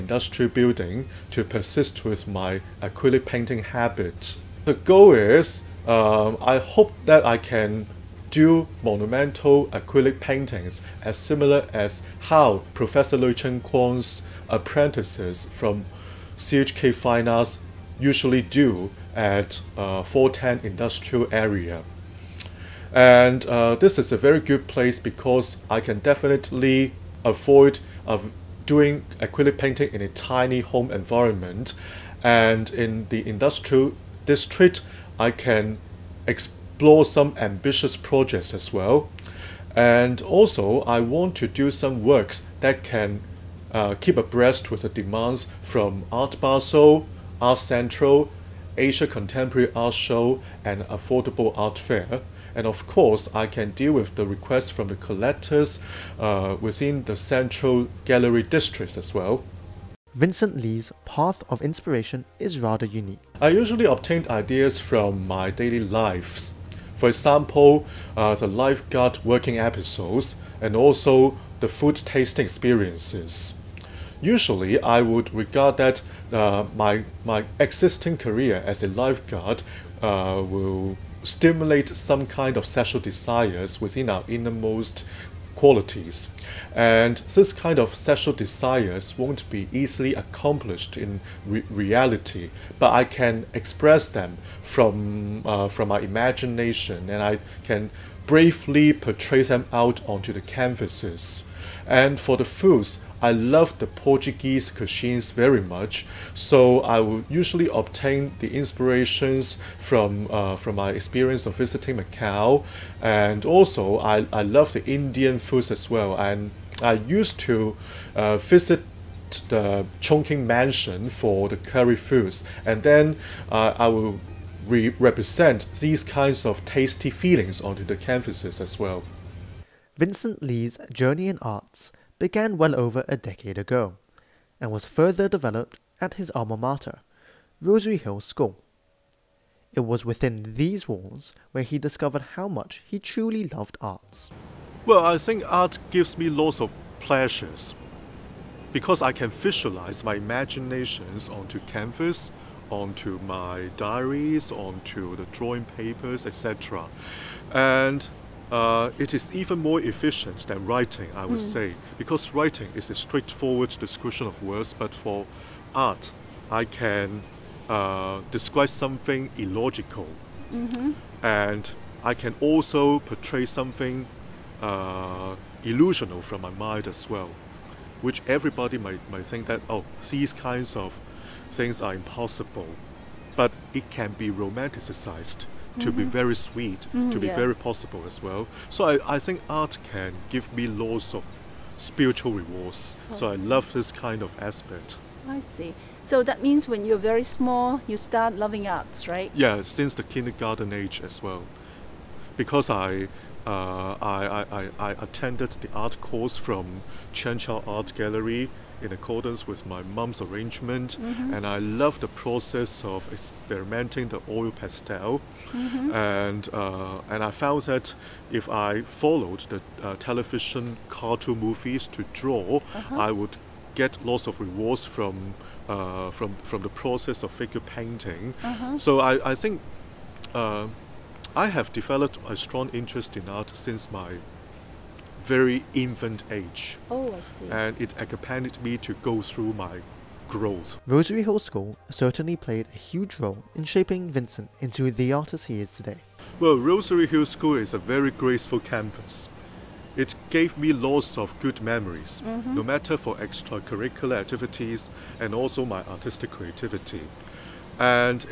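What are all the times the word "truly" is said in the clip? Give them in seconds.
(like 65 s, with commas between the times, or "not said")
142 s.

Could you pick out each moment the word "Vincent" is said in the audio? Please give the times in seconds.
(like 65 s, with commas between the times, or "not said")
60 s, 129 s, 244 s.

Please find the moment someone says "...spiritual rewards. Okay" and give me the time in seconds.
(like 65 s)
191 s.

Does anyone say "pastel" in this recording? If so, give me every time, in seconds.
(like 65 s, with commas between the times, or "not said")
214 s.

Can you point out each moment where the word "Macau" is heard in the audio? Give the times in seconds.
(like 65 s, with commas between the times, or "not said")
111 s.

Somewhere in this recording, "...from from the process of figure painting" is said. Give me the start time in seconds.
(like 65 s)
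226 s.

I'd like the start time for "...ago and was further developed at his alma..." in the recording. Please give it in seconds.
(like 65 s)
133 s.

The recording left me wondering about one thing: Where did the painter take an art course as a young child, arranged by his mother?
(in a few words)
Chao Art Gallery.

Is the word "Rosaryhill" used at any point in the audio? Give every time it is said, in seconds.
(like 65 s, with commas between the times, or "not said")
137 s, 240 s, 246 s.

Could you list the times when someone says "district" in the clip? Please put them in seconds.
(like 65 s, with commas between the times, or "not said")
34 s, 58 s.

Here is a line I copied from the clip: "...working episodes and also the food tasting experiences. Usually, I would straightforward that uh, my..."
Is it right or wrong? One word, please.
wrong.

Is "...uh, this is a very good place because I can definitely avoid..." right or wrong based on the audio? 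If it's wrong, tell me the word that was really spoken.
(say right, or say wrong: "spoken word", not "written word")
right.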